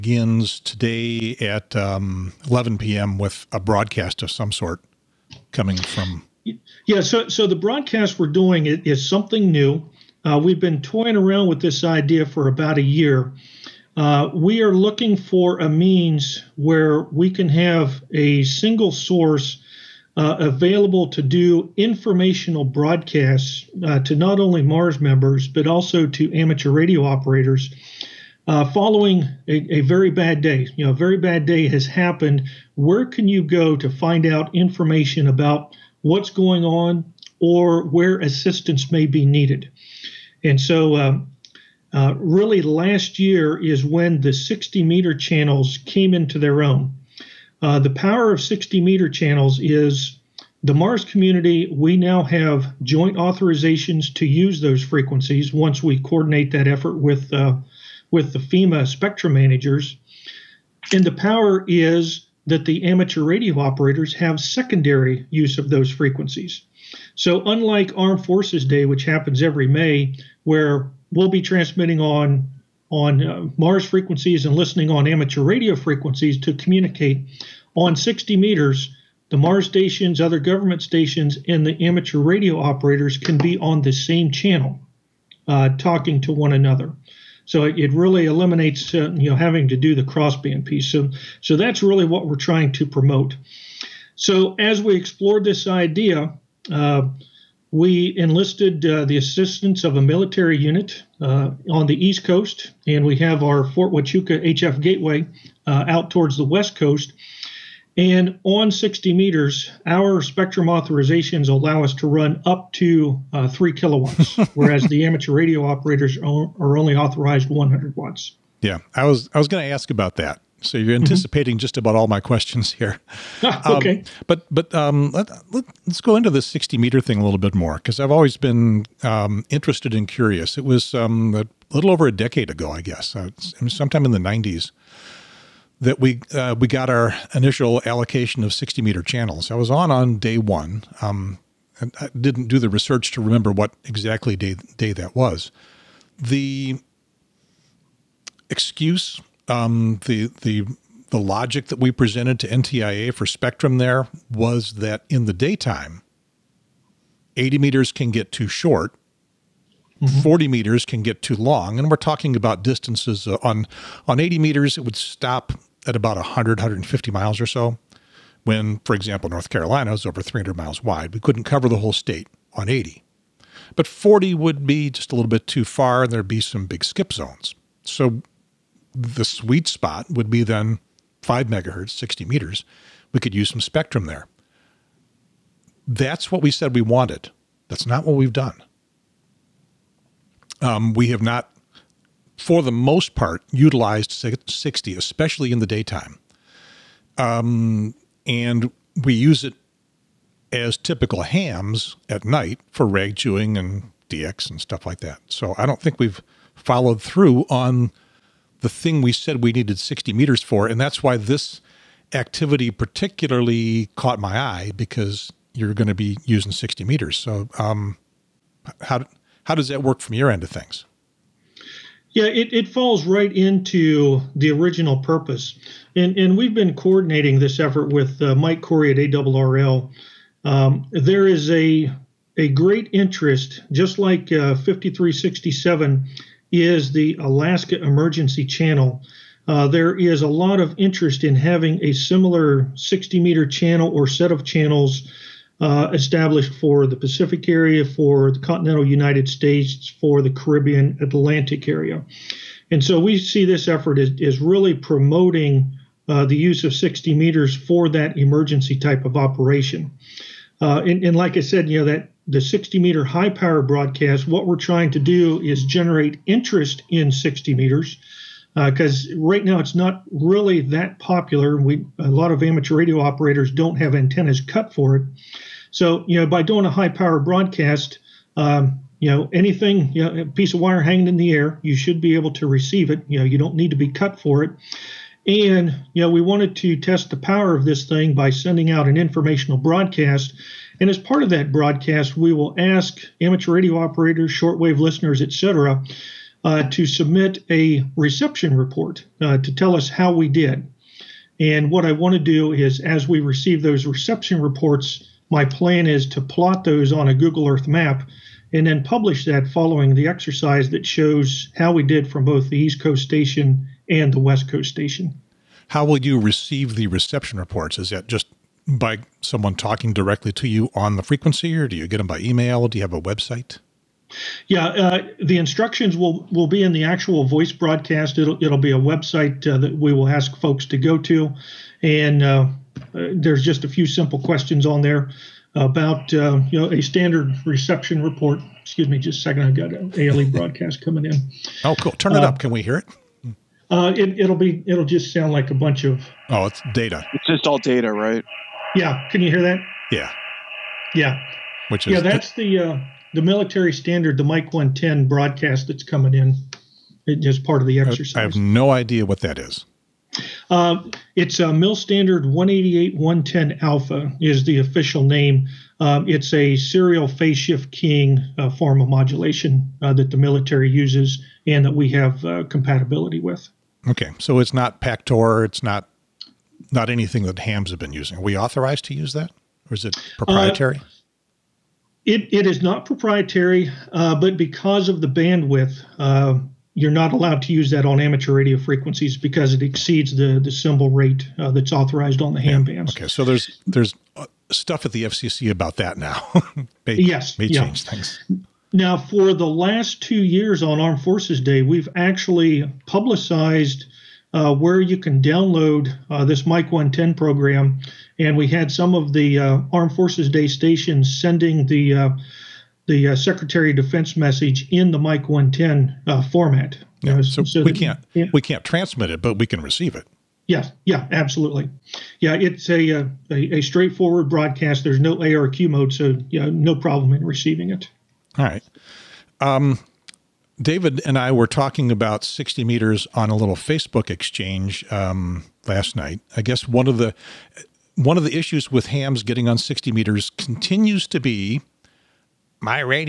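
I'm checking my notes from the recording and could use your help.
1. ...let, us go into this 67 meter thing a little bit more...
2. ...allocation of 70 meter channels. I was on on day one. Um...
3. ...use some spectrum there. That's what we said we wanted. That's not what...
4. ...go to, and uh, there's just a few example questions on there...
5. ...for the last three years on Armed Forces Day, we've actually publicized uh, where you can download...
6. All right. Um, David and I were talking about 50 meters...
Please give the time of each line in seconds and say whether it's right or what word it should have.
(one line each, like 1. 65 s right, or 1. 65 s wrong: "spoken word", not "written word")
1. 125 s wrong: "60", not "67"
2. 137 s wrong: "60", not "70"
3. 183 s right
4. 330 s wrong: "simple", not "example"
5. 398 s wrong: "two", not "three"
6. 428 s wrong: "60", not "50".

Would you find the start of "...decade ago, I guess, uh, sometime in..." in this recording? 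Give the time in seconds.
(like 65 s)
132 s.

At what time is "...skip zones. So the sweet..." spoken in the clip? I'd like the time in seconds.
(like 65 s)
176 s.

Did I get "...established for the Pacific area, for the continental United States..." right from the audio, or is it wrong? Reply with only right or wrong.
right.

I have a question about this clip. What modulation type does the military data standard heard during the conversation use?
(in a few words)
serial phase shift keying.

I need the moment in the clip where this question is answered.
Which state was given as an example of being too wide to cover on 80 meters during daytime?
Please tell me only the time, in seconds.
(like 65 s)
169 s.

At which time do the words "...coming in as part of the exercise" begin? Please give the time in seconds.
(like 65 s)
355 s.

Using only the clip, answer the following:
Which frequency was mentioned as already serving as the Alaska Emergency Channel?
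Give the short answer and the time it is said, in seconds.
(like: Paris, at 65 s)
5367, at 234 s.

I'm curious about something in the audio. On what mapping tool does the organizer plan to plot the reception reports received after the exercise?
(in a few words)
Google Earth.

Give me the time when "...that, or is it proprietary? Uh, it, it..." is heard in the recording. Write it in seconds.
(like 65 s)
379 s.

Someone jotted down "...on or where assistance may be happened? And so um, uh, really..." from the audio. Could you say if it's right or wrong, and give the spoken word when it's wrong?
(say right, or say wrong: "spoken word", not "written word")
wrong: "needed", not "happened".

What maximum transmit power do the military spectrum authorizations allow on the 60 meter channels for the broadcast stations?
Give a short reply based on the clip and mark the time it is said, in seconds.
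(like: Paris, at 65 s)
3 kilowatts, at 113 s.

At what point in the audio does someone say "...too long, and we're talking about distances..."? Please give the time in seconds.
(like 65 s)
161 s.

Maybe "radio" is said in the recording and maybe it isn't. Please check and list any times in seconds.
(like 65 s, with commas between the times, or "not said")
26 s, 63 s, 75 s, 82 s, 115 s, 272 s, 293 s, 388 s.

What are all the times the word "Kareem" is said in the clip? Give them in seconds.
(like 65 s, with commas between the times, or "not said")
not said.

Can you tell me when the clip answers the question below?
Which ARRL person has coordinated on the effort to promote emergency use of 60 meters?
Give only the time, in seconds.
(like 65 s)
228 s.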